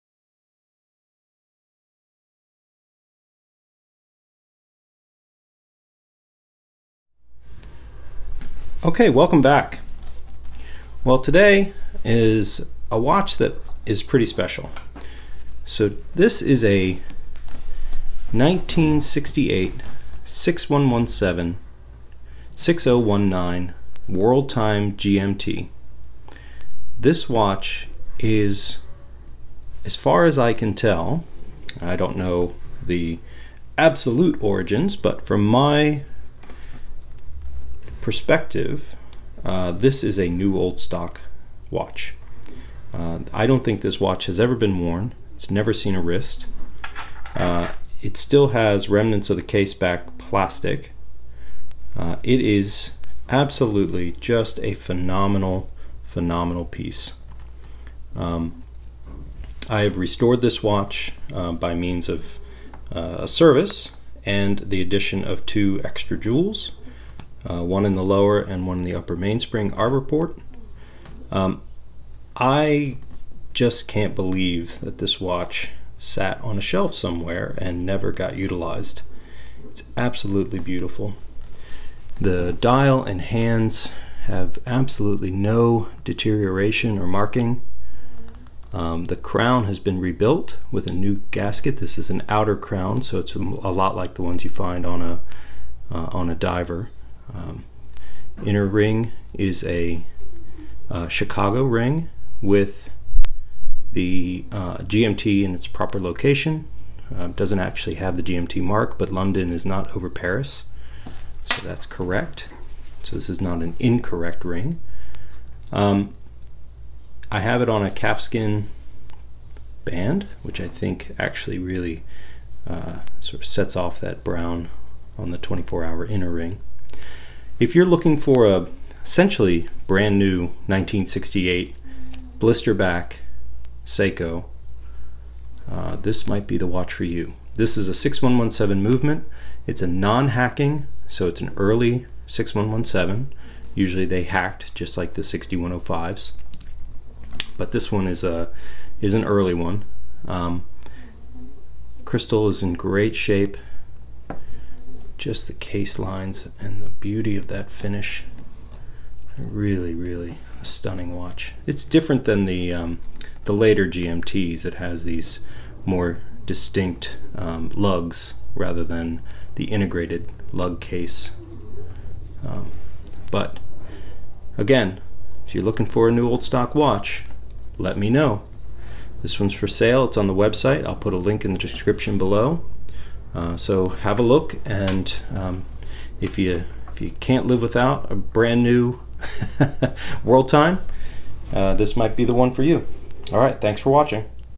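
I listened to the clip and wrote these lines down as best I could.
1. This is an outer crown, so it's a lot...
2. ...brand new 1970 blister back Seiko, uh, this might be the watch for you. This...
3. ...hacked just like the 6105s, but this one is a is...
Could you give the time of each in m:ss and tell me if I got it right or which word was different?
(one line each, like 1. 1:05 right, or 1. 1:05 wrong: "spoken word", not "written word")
1. 1:31 right
2. 2:09 wrong: "1968", not "1970"
3. 2:24 right.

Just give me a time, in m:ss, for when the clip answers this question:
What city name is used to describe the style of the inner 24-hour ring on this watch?
1:41.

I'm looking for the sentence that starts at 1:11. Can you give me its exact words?
Um, I just can't believe that this watch sat on a shelf somewhere and never got utilized.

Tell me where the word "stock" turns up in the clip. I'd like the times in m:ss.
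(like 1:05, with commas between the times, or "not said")
0:40, 2:56.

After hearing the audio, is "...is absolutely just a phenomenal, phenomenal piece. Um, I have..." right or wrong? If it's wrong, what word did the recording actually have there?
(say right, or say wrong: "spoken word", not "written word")
right.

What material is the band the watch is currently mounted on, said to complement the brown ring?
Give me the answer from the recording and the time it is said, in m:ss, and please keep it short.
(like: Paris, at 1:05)
Calfskin, at 1:57.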